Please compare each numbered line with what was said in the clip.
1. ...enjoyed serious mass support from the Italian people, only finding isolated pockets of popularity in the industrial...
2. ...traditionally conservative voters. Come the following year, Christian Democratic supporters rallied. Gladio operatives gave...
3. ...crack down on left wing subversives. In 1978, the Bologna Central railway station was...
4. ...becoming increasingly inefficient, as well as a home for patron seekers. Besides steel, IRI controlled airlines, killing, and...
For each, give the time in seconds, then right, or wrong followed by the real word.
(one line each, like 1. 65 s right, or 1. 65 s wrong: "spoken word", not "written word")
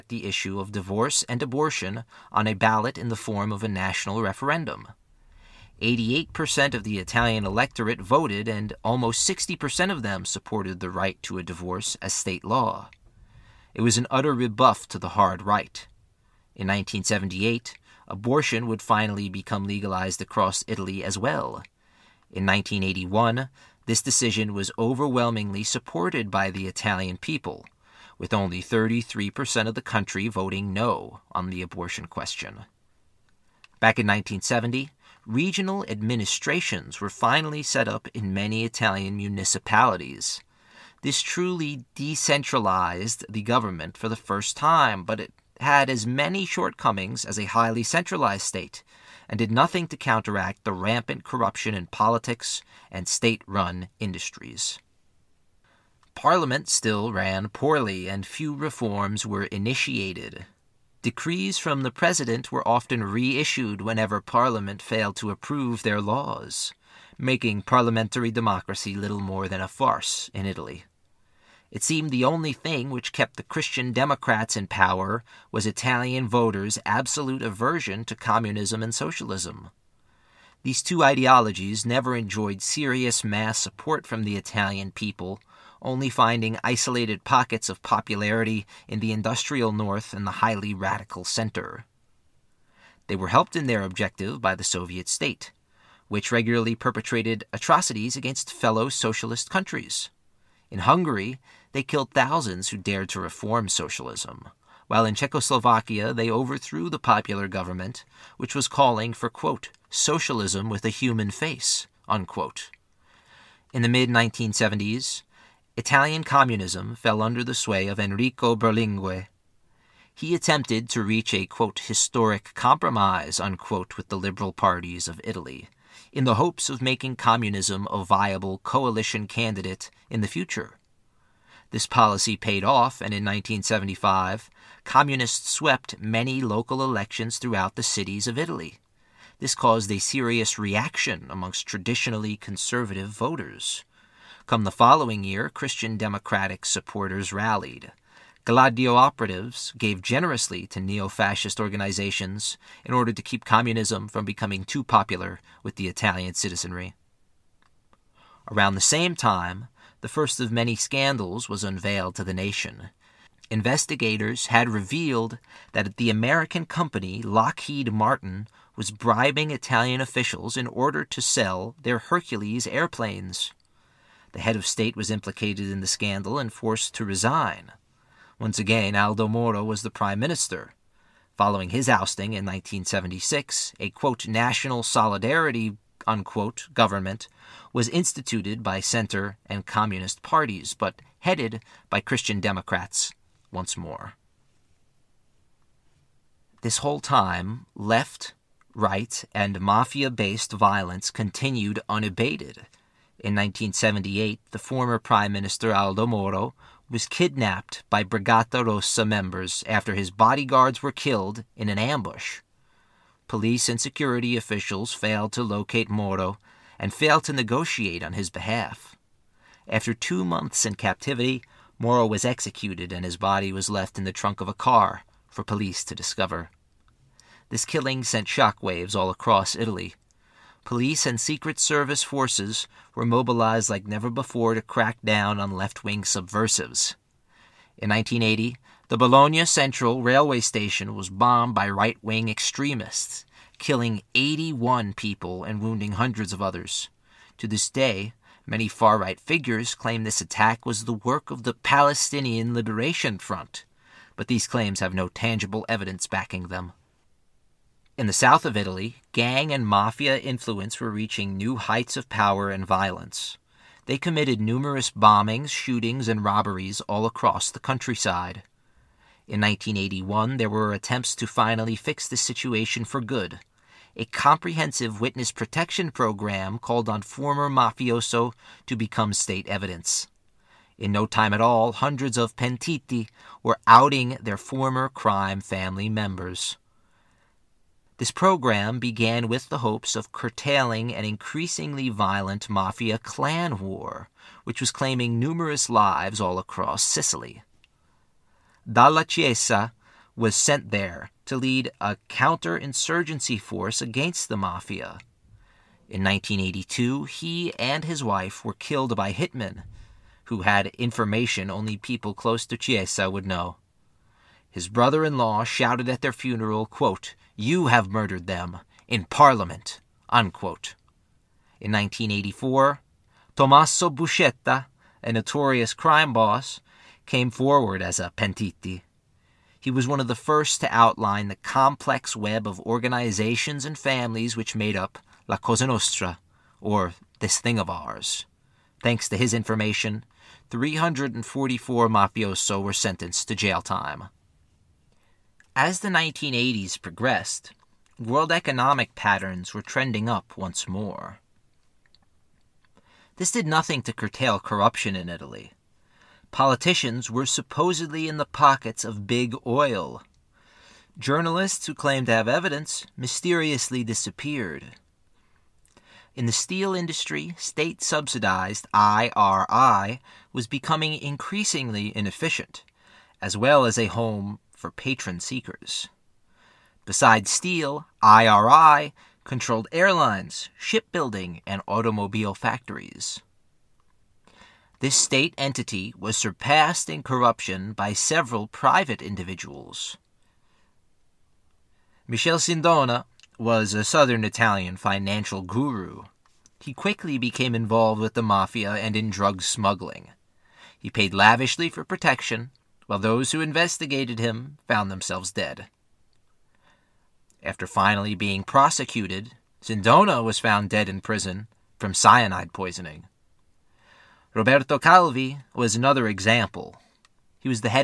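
1. 82 s right
2. 141 s right
3. 234 s wrong: "1980", not "1978"
4. 370 s wrong: "shipbuilding", not "killing".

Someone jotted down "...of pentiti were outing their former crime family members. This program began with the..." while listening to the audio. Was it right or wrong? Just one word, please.
right.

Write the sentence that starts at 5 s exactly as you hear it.
88% of the Italian electorate voted, and almost 60% of them supported the right to a divorce as state law.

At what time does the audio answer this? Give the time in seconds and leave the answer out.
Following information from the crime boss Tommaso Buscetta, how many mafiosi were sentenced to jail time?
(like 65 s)
340 s.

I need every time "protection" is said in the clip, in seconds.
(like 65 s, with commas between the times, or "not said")
275 s, 401 s.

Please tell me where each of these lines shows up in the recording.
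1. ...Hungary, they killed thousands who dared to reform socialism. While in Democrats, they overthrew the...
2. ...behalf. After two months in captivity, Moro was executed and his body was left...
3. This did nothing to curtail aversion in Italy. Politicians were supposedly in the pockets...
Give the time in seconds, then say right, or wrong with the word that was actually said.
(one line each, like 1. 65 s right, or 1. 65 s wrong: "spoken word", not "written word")
1. 100 s wrong: "Czechoslovakia", not "Democrats"
2. 218 s right
3. 353 s wrong: "corruption", not "aversion".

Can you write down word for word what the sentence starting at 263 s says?
They committed numerous bombings, shootings, and robberies all across the countryside.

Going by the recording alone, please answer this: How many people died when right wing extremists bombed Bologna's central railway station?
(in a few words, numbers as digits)
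81.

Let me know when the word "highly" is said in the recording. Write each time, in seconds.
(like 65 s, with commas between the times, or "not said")
47 s, 90 s.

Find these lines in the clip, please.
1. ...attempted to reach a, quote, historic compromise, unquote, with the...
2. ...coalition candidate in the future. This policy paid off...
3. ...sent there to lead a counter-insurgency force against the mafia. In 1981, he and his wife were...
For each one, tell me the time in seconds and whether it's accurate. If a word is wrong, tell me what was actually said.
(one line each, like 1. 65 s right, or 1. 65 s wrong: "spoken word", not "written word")
1. 120 s right
2. 128 s right
3. 300 s wrong: "1982", not "1981".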